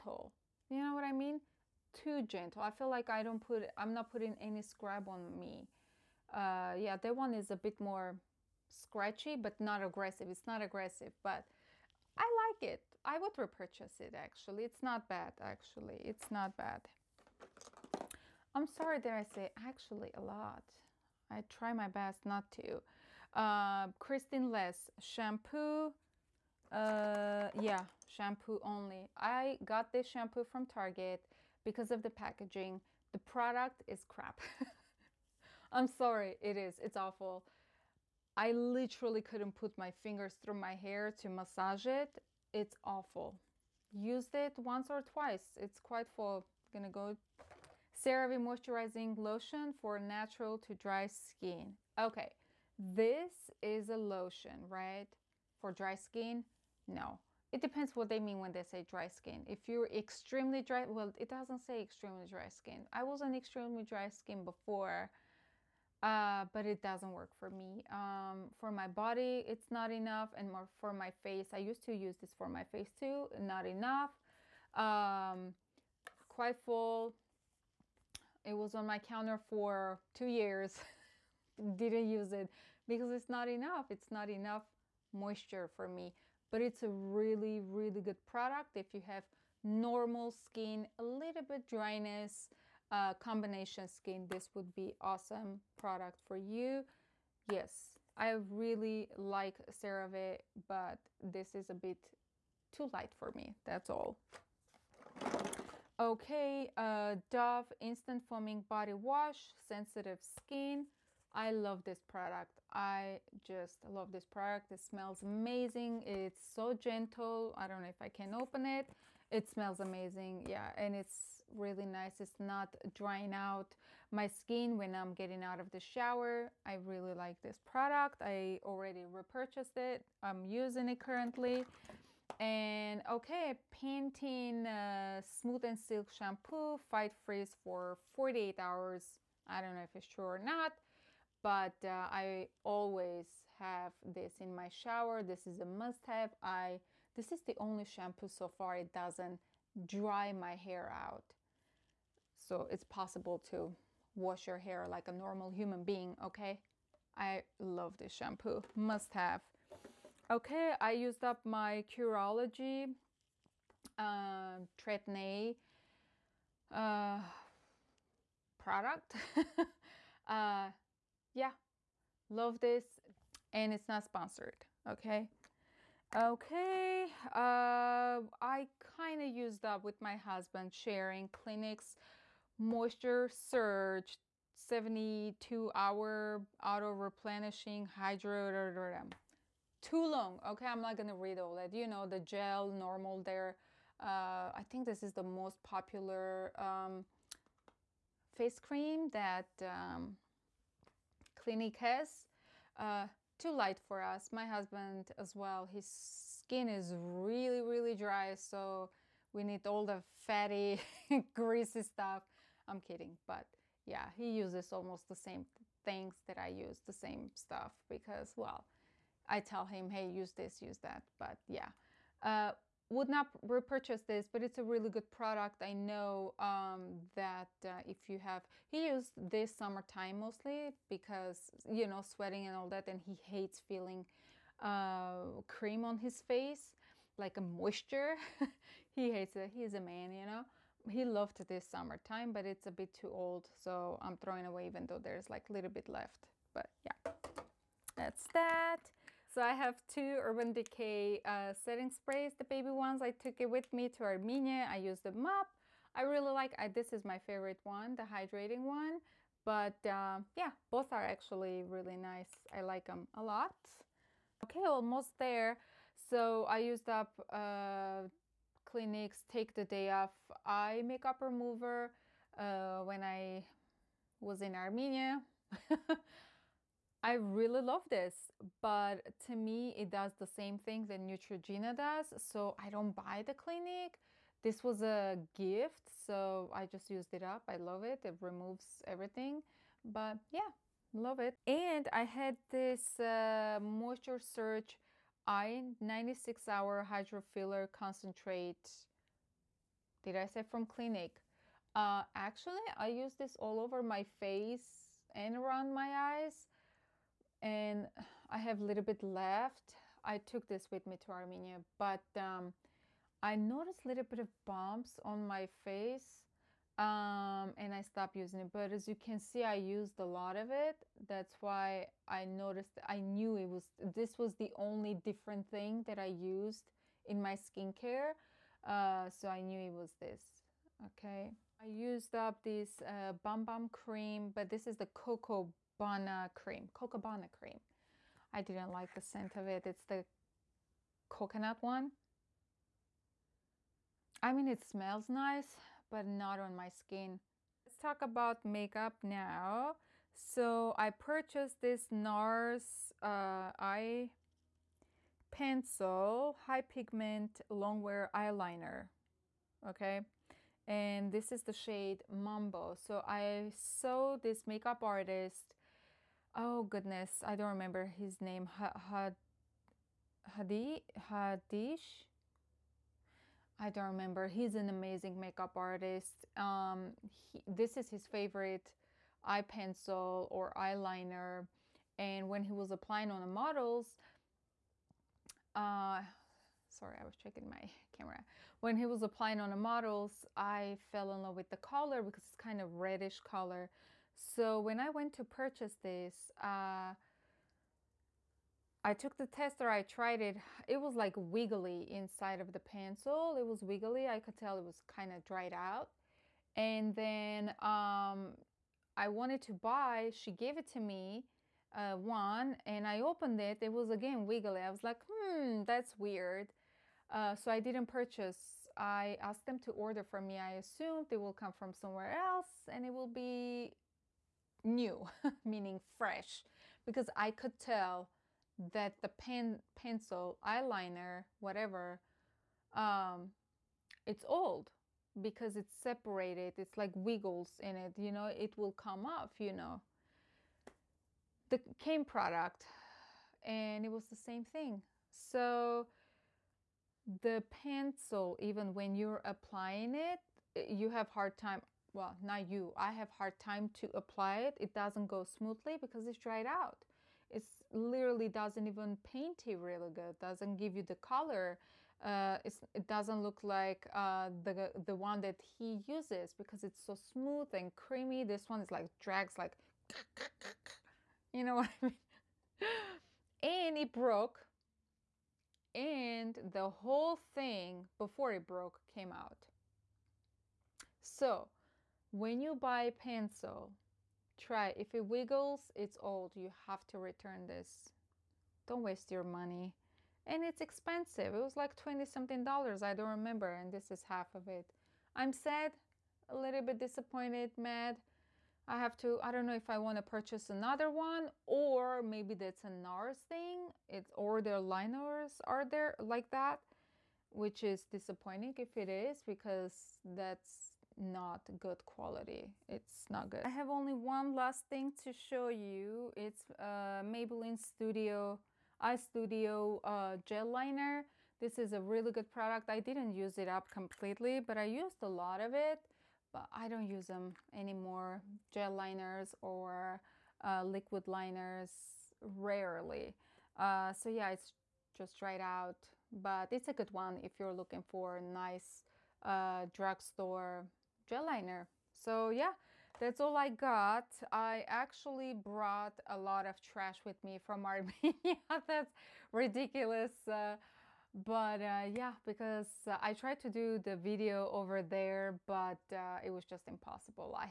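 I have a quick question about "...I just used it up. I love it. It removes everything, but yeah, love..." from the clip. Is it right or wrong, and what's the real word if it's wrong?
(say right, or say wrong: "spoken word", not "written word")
right.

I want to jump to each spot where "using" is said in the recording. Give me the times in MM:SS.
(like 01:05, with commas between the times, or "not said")
02:10, 05:18.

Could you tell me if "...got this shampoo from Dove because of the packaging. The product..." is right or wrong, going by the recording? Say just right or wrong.
wrong.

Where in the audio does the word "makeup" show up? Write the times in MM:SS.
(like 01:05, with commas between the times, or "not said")
04:30, 05:48, 06:04, 06:15.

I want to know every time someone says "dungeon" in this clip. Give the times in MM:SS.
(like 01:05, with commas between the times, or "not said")
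not said.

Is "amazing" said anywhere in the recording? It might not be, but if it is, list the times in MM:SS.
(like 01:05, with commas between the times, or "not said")
01:55, 01:59, 06:14.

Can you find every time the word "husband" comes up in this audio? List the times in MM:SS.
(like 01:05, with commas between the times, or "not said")
03:00, 03:24.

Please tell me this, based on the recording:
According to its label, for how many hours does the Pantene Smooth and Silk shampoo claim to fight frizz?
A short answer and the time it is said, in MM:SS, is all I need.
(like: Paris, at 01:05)
48, at 02:17.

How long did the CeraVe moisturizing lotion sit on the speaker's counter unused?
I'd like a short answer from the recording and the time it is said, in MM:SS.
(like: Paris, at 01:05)
2 years, at 01:20.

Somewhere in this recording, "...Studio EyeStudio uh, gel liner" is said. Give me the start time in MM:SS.
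08:37.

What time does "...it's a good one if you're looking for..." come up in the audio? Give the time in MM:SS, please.
08:56.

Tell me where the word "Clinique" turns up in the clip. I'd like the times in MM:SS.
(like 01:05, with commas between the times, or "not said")
03:01, 03:21, 04:28, 04:43, 05:00.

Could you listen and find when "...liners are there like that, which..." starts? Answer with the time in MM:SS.
08:24.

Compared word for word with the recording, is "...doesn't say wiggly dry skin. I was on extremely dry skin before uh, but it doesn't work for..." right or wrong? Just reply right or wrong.
wrong.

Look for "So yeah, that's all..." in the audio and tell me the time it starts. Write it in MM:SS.
09:01.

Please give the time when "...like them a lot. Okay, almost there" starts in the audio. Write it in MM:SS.
04:22.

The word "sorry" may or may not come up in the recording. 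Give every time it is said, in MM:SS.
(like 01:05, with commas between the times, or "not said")
00:18, 00:35, 06:26.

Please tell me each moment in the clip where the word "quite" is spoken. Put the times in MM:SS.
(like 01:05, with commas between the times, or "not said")
00:45, 01:16.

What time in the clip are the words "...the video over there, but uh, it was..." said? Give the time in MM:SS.
09:13.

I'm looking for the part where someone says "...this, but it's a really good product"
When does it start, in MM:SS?
03:44.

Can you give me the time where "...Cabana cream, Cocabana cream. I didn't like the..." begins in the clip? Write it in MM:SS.
05:35.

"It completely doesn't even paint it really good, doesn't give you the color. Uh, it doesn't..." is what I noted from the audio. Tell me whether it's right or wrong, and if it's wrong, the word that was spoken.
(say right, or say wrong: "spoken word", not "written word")
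wrong: "literally", not "completely".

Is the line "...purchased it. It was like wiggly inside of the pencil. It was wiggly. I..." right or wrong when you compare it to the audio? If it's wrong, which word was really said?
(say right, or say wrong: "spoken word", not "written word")
wrong: "tried", not "purchased".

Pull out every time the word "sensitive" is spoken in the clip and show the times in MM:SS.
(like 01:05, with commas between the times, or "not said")
01:49.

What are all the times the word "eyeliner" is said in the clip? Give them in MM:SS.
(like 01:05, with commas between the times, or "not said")
05:58, 06:20, 07:10.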